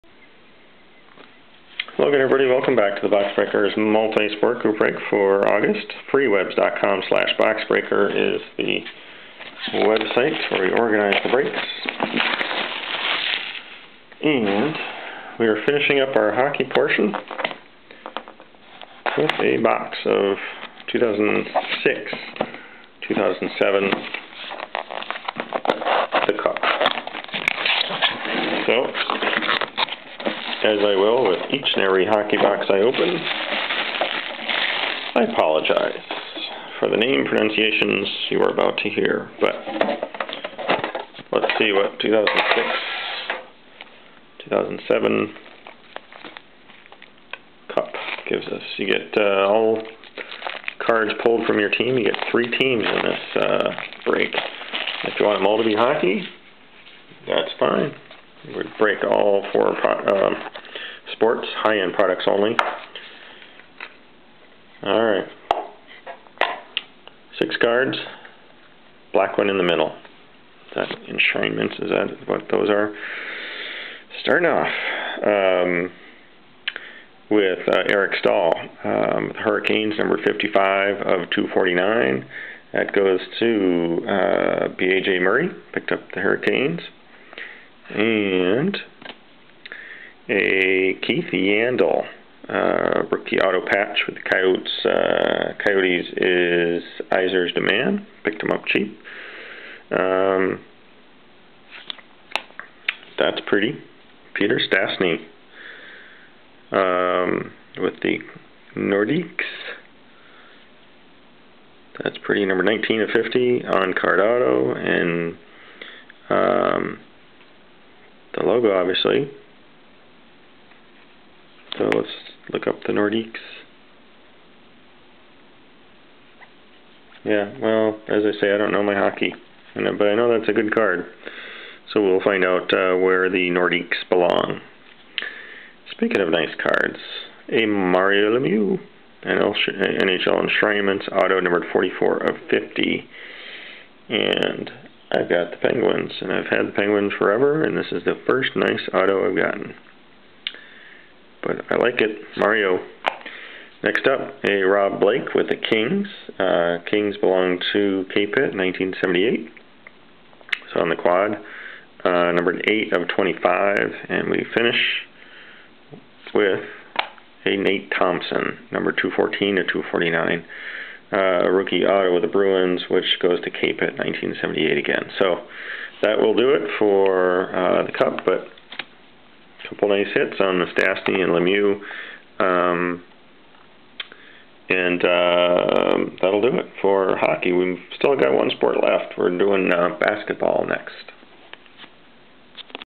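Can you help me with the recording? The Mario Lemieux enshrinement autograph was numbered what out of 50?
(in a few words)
44.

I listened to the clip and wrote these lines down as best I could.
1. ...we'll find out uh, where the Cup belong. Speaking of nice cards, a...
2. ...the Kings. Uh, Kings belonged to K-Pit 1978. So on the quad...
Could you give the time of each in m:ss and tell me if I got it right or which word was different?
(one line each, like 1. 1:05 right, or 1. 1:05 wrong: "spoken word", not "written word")
1. 2:12 wrong: "Nordiques", not "Cup"
2. 2:35 right.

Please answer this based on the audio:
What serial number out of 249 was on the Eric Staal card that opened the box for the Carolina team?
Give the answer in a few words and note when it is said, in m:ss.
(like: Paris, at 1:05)
55, at 1:20.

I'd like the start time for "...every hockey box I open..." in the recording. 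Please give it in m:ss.
0:31.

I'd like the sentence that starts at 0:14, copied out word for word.
And we are finishing up our hockey portion with a box of 2006, 2007, the cup.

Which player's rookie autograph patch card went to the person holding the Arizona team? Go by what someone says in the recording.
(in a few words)
Keith Yandle.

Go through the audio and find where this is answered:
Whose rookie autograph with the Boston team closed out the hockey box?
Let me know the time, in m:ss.
2:47.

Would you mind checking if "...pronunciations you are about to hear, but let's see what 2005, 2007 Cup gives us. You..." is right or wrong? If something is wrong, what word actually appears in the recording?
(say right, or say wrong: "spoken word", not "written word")
wrong: "2006", not "2005".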